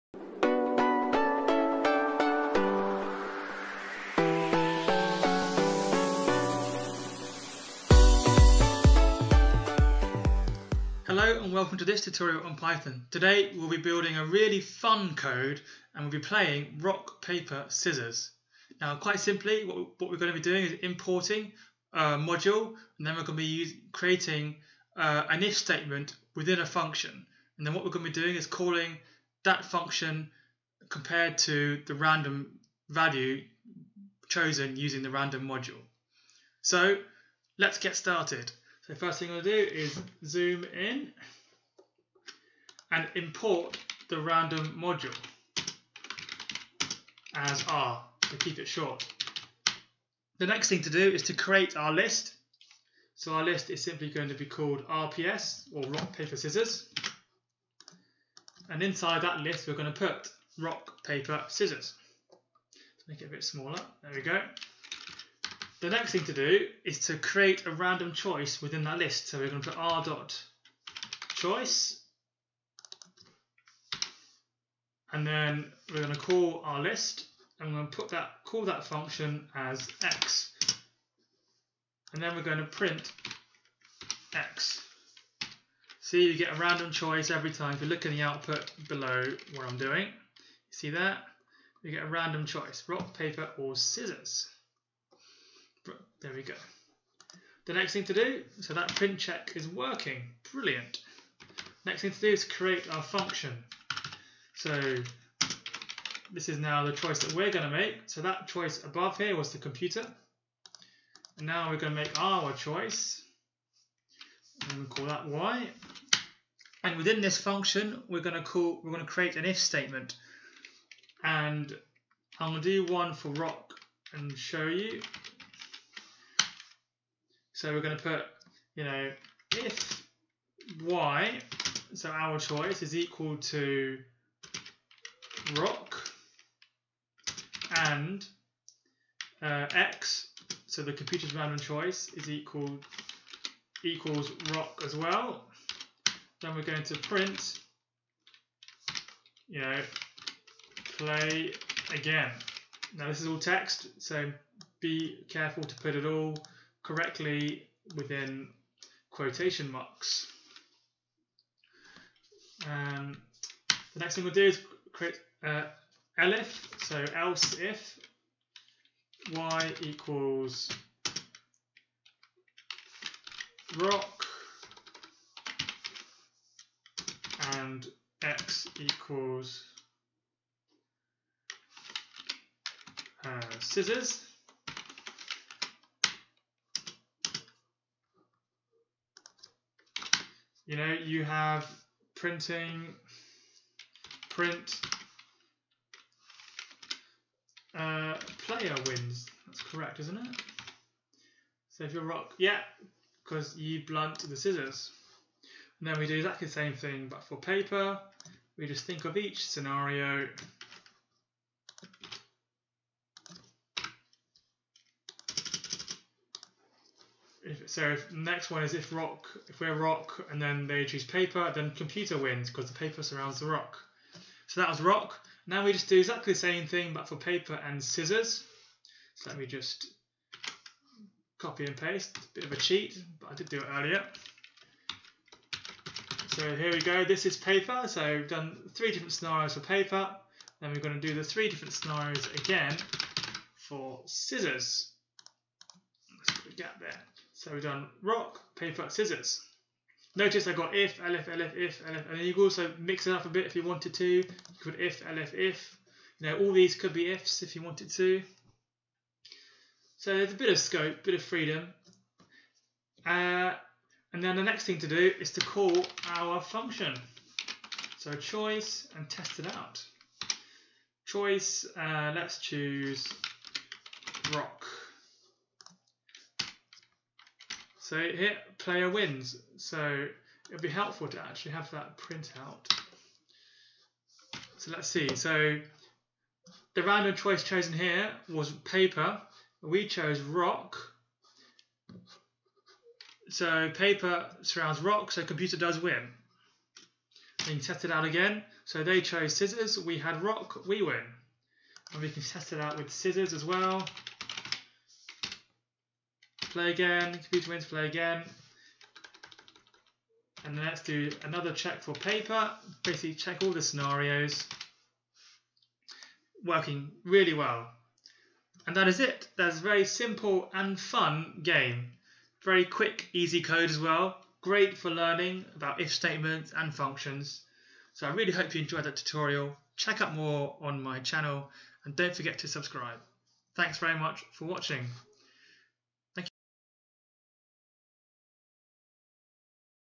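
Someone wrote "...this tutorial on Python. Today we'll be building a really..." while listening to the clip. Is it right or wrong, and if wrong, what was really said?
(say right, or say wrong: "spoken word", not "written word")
right.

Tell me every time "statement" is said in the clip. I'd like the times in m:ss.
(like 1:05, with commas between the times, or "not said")
0:25, 1:59, 5:25.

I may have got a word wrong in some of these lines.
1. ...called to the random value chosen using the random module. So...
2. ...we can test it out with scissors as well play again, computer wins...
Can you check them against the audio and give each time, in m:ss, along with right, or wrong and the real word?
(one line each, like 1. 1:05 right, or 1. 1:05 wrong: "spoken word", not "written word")
1. 0:30 wrong: "compared", not "called"
2. 5:02 right.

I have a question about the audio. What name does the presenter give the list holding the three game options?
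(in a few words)
RPS.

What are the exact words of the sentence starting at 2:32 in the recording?
Now this is all text, so be careful to put it all correctly within quotation marks.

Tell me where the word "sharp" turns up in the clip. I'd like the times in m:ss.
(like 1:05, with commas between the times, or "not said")
not said.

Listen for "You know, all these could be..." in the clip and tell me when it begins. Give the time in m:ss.
4:16.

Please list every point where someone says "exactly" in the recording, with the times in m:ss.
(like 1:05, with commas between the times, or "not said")
3:26, 3:45.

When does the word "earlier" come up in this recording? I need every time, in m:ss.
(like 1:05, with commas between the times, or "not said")
3:53.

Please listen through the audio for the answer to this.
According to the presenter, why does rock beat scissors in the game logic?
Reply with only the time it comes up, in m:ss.
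3:23.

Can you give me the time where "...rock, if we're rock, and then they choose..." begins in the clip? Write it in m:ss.
3:38.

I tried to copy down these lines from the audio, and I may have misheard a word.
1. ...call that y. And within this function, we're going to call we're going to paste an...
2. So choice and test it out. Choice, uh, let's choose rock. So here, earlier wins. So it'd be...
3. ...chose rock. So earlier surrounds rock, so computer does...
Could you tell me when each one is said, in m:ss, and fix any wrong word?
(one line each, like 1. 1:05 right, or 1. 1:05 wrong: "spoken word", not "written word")
1. 1:54 wrong: "create", not "paste"
2. 4:27 wrong: "player", not "earlier"
3. 4:49 wrong: "paper", not "earlier".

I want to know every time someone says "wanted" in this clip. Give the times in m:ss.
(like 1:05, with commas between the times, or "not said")
4:13, 4:17.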